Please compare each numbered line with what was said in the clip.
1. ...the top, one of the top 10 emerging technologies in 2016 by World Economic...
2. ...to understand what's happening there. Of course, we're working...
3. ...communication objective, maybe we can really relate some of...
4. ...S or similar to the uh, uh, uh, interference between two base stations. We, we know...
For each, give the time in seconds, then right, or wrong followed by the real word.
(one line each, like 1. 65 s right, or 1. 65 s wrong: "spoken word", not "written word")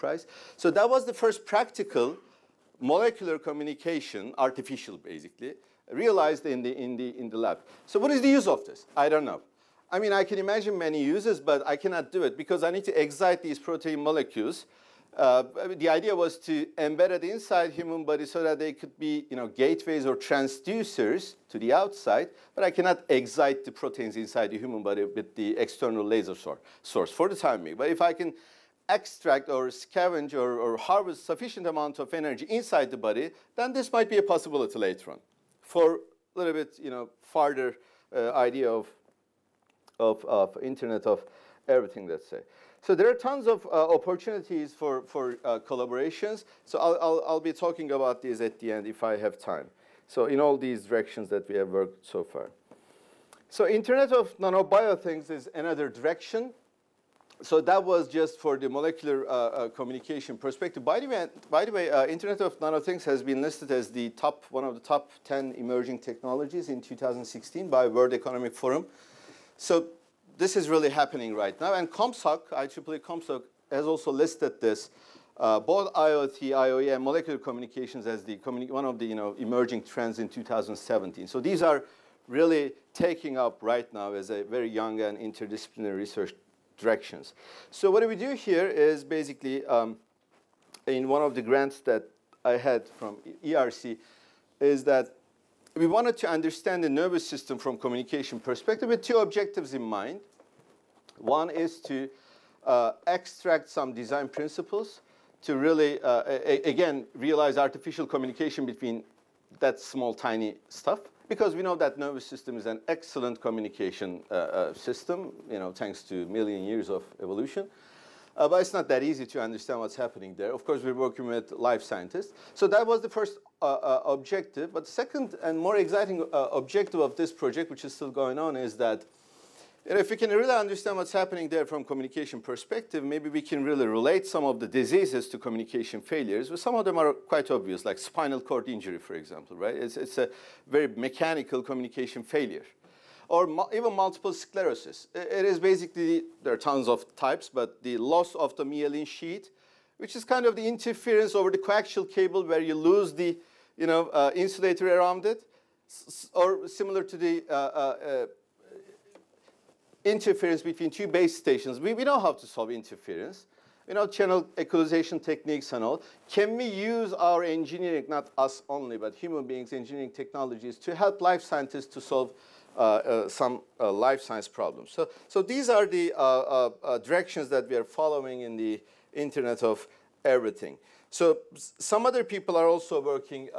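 1. 63 s right
2. 119 s right
3. 131 s wrong: "perspective", not "objective"
4. 155 s right.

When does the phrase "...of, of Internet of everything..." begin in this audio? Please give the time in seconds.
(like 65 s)
39 s.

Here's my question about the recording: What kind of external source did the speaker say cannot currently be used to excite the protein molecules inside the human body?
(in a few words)
Laser source.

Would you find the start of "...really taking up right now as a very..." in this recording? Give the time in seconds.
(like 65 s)
82 s.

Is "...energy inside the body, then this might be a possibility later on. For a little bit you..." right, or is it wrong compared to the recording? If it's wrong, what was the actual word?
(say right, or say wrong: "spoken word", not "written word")
right.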